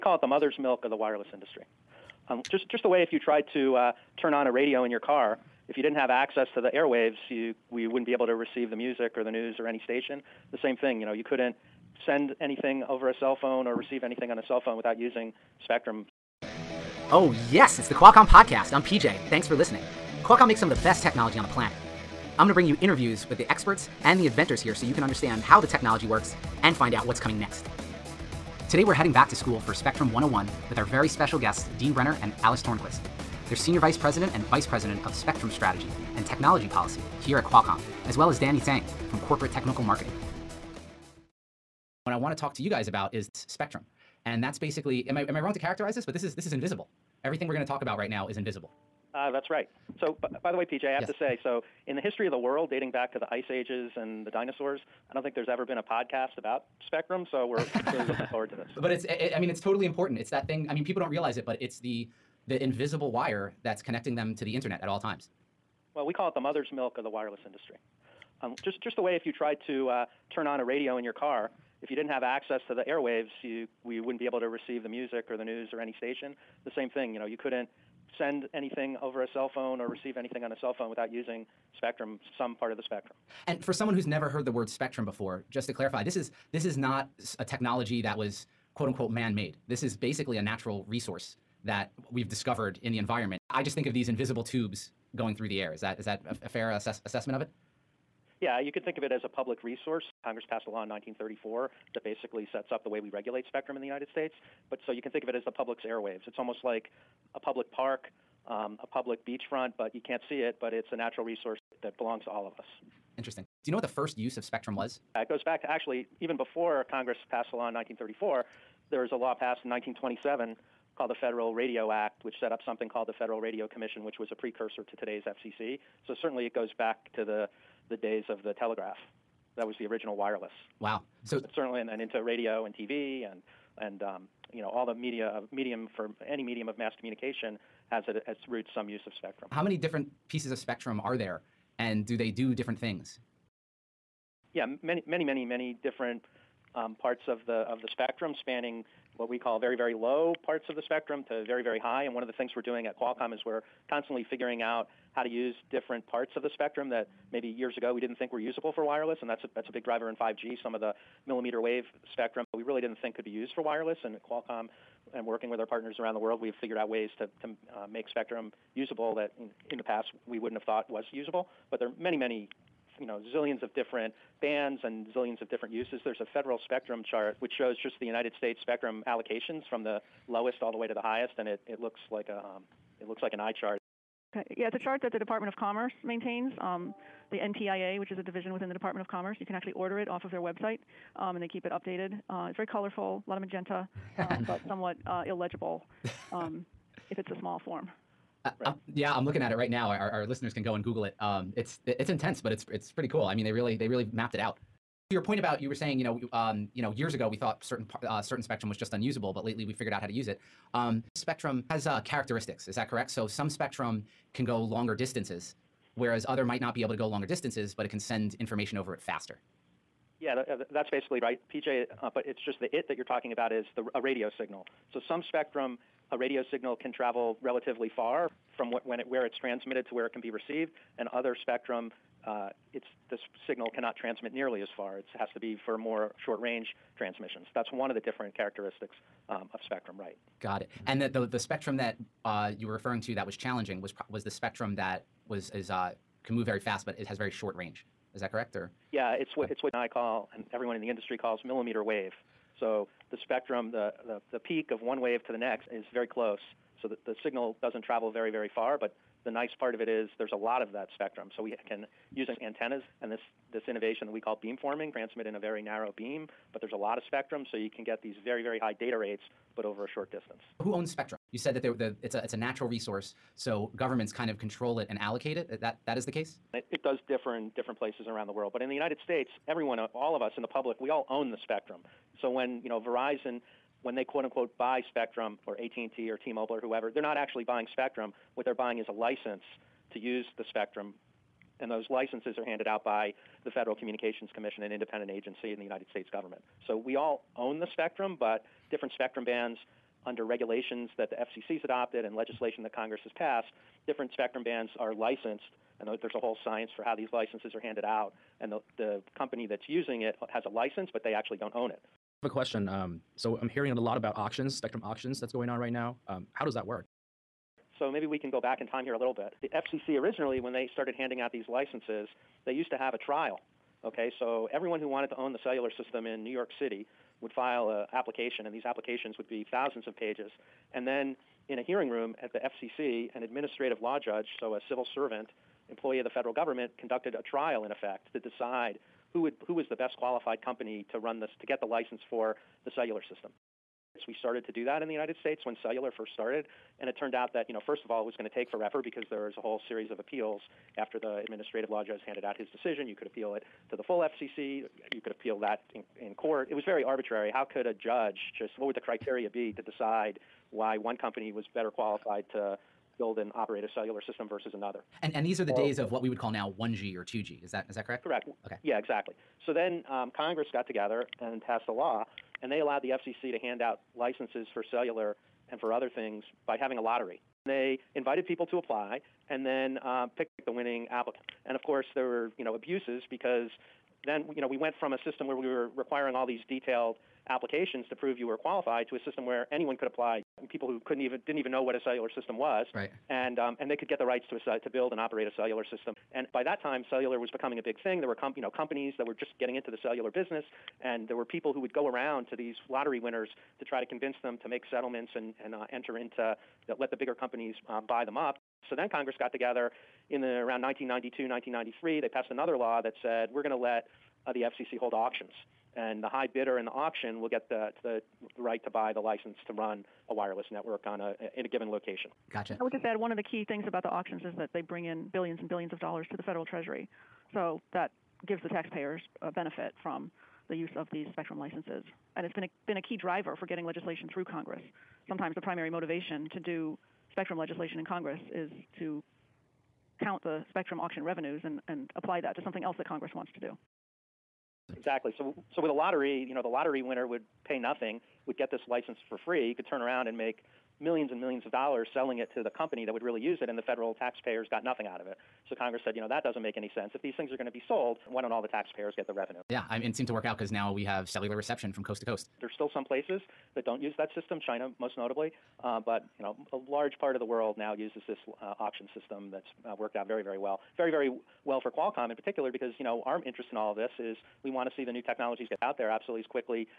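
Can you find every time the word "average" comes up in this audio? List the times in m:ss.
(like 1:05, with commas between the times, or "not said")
not said.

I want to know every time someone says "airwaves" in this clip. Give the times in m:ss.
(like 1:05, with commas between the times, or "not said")
0:06, 1:12, 1:45.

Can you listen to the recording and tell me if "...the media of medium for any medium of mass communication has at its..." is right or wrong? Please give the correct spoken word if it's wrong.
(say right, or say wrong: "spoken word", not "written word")
right.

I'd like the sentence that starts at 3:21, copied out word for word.
Um, it's it's intense, but it's it's pretty cool.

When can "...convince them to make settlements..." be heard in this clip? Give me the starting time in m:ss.
6:43.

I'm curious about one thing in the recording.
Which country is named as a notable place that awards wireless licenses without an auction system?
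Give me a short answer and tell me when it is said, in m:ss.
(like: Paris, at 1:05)
China, at 7:44.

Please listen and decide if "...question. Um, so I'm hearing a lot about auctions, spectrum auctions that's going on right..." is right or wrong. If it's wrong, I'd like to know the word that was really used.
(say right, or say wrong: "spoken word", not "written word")
right.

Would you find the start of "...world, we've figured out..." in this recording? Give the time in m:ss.
2:46.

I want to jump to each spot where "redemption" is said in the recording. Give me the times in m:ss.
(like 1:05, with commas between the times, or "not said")
not said.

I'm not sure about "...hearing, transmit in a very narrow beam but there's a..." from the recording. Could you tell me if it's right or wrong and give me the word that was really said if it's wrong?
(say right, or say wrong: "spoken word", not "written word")
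wrong: "beamforming", not "hearing".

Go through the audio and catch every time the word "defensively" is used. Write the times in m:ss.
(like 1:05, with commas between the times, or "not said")
not said.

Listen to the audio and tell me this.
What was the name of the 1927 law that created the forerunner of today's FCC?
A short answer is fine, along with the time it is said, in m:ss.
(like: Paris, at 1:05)
Federal Radio Act, at 2:01.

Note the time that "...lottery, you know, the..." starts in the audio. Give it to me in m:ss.
7:25.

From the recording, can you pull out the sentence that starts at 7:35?
So Congress said, you know, that doesn't make any sense.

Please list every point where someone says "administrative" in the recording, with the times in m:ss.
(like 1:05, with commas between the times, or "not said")
5:33, 5:51.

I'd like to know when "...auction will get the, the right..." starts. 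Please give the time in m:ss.
6:56.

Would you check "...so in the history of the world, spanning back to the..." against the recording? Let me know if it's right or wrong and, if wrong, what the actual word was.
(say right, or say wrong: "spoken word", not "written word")
wrong: "dating", not "spanning".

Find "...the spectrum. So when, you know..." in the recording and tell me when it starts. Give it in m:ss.
4:41.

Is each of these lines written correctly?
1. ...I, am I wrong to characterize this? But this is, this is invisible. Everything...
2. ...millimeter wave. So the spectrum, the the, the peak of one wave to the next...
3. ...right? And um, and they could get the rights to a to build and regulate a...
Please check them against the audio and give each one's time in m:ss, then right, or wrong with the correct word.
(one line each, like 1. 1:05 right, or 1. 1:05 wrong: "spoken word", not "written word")
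1. 0:45 right
2. 4:11 right
3. 6:32 wrong: "operate", not "regulate".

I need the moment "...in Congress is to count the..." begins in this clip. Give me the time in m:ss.
7:17.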